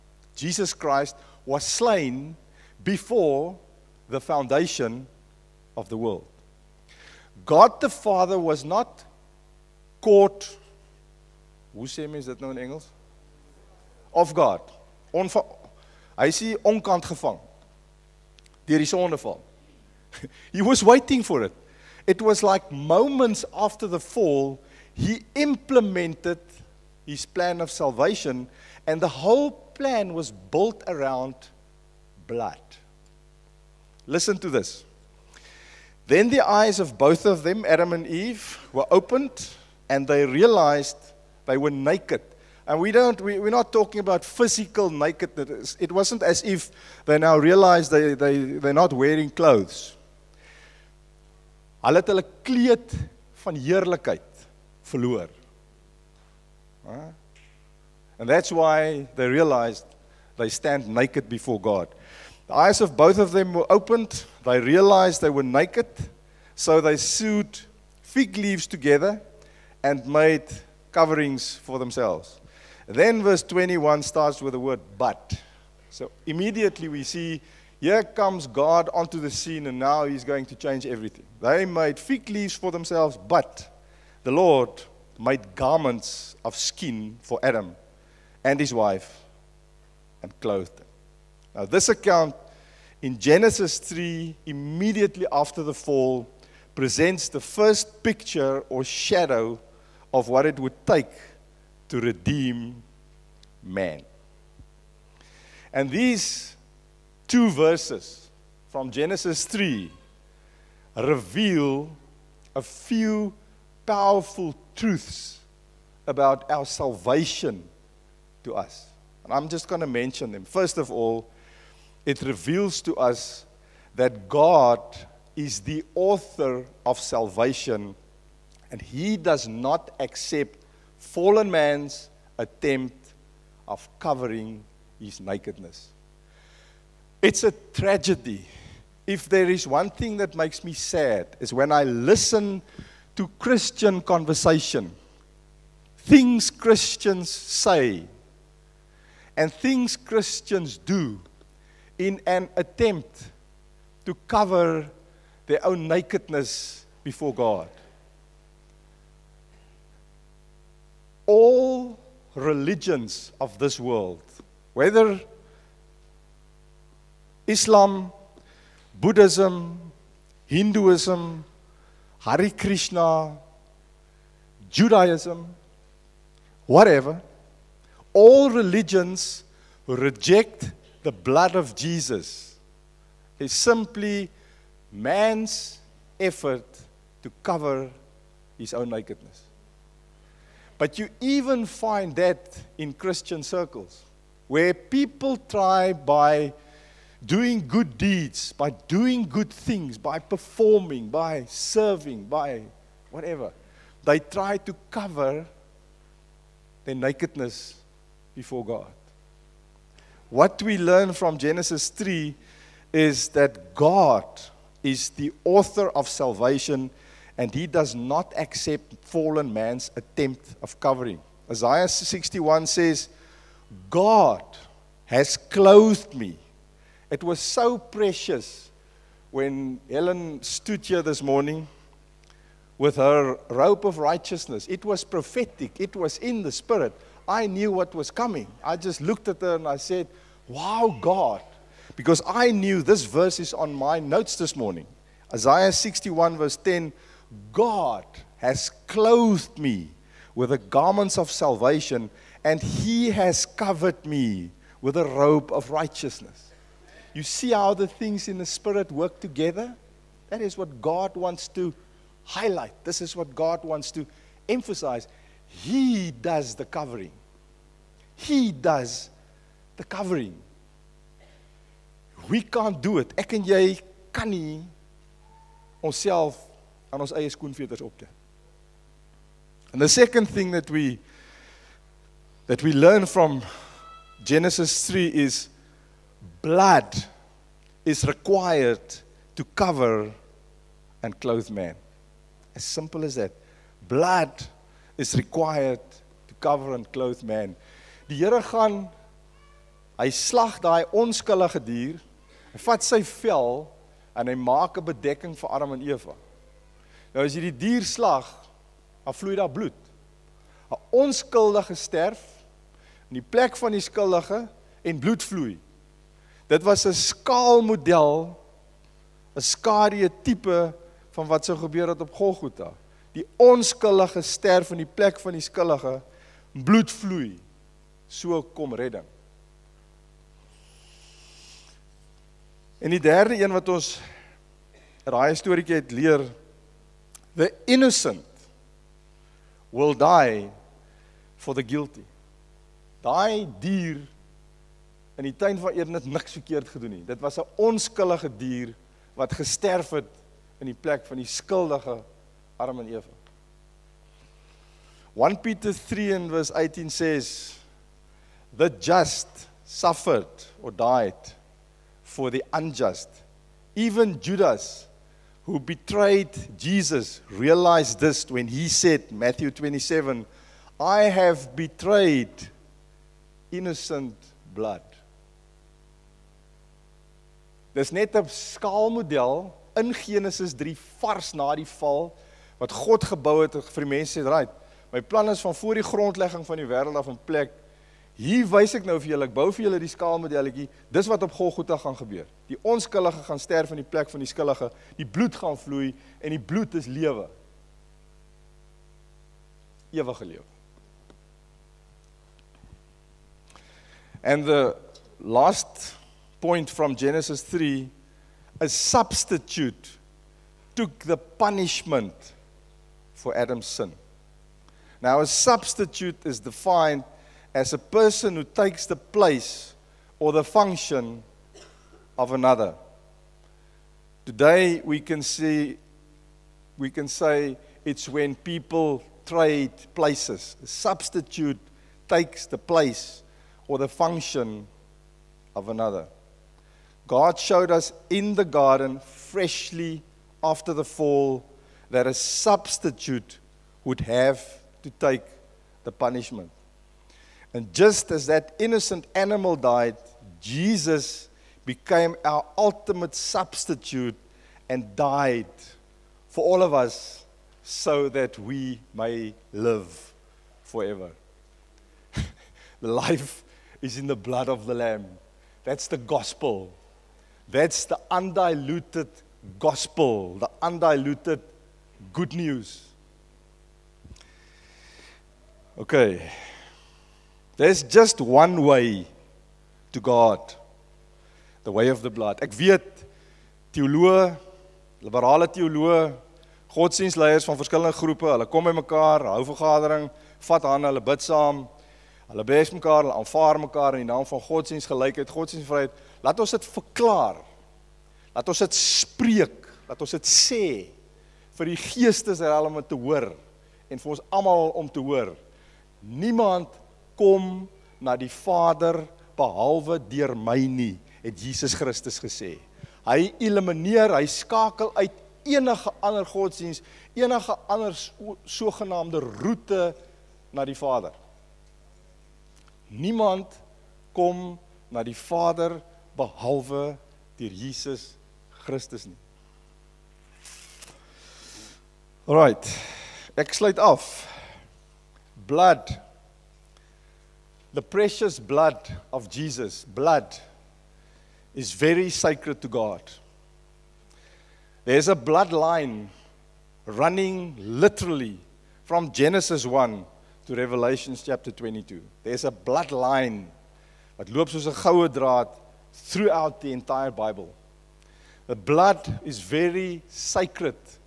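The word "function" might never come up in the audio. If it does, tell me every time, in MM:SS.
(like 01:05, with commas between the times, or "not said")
07:00, 07:13.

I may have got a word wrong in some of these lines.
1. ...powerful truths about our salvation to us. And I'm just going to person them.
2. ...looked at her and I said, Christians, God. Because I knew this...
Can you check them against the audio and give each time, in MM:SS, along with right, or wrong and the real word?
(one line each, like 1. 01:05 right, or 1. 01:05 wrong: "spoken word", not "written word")
1. 01:53 wrong: "mention", not "person"
2. 03:59 wrong: "Wow", not "Christians".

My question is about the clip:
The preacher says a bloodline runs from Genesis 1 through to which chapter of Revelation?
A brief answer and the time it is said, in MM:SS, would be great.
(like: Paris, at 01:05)
Chapter 22, at 09:11.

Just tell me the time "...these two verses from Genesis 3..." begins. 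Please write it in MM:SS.
01:45.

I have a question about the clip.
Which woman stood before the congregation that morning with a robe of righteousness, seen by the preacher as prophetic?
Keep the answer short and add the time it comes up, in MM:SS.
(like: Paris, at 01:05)
Helen, at 03:49.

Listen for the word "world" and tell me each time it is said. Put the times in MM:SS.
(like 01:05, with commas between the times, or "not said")
00:05, 02:43.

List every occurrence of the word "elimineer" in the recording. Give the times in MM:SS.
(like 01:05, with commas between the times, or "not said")
08:33.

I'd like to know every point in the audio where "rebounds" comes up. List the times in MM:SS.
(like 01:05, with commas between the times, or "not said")
not said.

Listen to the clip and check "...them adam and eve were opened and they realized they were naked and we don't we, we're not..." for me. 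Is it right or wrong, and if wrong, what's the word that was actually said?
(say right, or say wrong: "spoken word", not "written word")
right.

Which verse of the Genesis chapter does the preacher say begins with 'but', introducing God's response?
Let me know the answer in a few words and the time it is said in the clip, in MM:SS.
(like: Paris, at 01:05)
Verse 21, at 01:13.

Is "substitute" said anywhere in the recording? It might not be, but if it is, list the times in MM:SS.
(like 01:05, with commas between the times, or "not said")
06:48, 06:55, 07:10, 07:22, 07:33.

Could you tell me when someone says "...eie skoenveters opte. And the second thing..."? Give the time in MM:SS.
04:37.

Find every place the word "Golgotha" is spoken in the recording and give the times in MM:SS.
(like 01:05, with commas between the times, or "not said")
05:22, 06:31.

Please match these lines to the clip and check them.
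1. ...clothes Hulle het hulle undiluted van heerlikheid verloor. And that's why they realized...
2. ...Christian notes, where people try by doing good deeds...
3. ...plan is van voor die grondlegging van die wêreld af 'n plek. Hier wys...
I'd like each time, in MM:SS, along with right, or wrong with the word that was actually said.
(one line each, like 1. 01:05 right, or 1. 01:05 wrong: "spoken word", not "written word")
1. 00:49 wrong: "kleed", not "undiluted"
2. 03:12 wrong: "circles", not "notes"
3. 06:25 right.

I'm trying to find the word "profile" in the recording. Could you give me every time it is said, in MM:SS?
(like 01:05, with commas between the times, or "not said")
not said.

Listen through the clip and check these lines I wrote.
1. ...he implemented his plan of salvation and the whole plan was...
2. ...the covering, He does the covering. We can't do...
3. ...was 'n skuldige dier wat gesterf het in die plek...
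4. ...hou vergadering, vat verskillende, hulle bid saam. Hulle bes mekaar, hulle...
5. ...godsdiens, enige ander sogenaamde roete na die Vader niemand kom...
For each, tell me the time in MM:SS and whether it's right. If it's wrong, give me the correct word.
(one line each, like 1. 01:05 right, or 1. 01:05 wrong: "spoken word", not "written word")
1. 00:24 right
2. 04:26 right
3. 05:47 wrong: "onskuldige", not "skuldige"
4. 08:09 wrong: "hande", not "verskillende"
5. 08:36 right.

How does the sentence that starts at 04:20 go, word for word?
That is what God wants to highlight.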